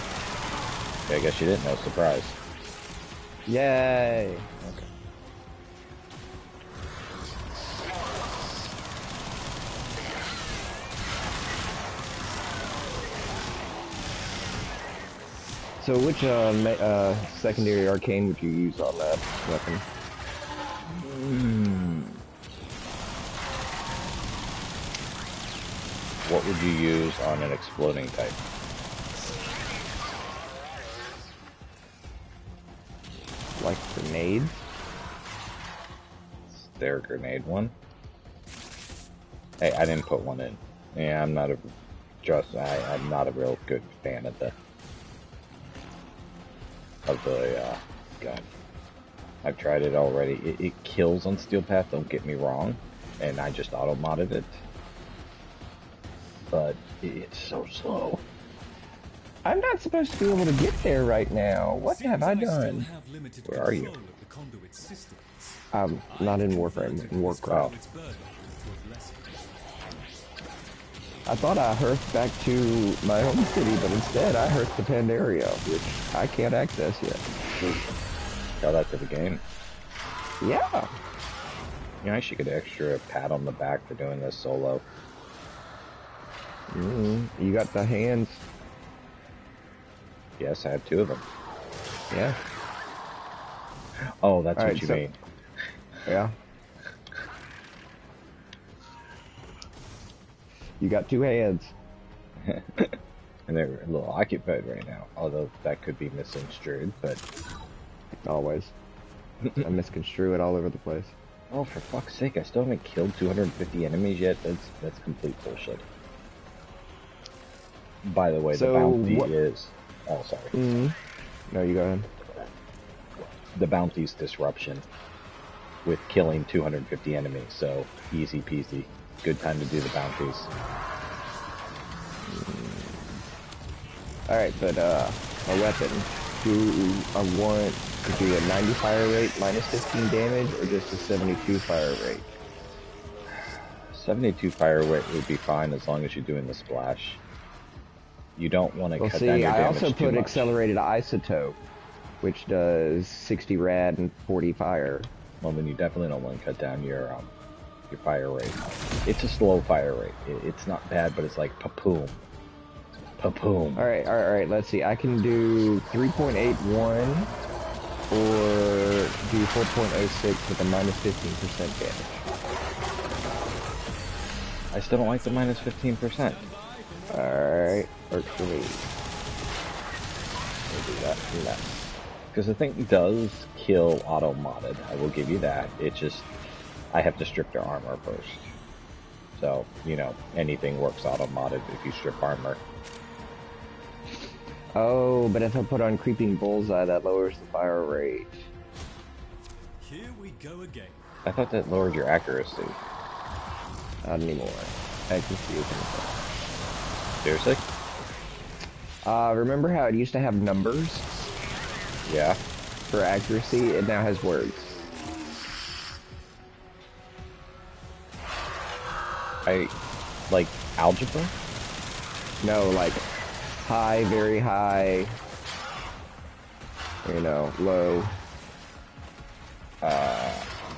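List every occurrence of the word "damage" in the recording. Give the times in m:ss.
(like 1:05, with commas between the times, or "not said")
2:20, 2:29, 2:51.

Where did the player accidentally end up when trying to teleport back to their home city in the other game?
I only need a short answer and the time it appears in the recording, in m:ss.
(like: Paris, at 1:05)
Pandaria, at 1:14.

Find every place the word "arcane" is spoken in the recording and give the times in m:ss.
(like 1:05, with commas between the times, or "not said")
0:17.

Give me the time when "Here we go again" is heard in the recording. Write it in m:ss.
3:19.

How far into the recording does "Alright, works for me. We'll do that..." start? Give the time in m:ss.
2:57.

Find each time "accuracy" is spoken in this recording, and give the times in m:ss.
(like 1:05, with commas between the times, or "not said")
3:22, 3:33.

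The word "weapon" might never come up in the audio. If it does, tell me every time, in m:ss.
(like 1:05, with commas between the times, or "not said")
0:19, 2:15.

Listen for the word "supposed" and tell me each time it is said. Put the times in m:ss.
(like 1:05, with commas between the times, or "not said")
0:59.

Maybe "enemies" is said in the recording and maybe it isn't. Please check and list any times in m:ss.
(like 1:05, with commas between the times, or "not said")
1:53, 2:07.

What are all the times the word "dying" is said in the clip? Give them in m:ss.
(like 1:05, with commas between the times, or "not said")
not said.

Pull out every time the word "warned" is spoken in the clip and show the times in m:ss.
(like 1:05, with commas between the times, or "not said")
not said.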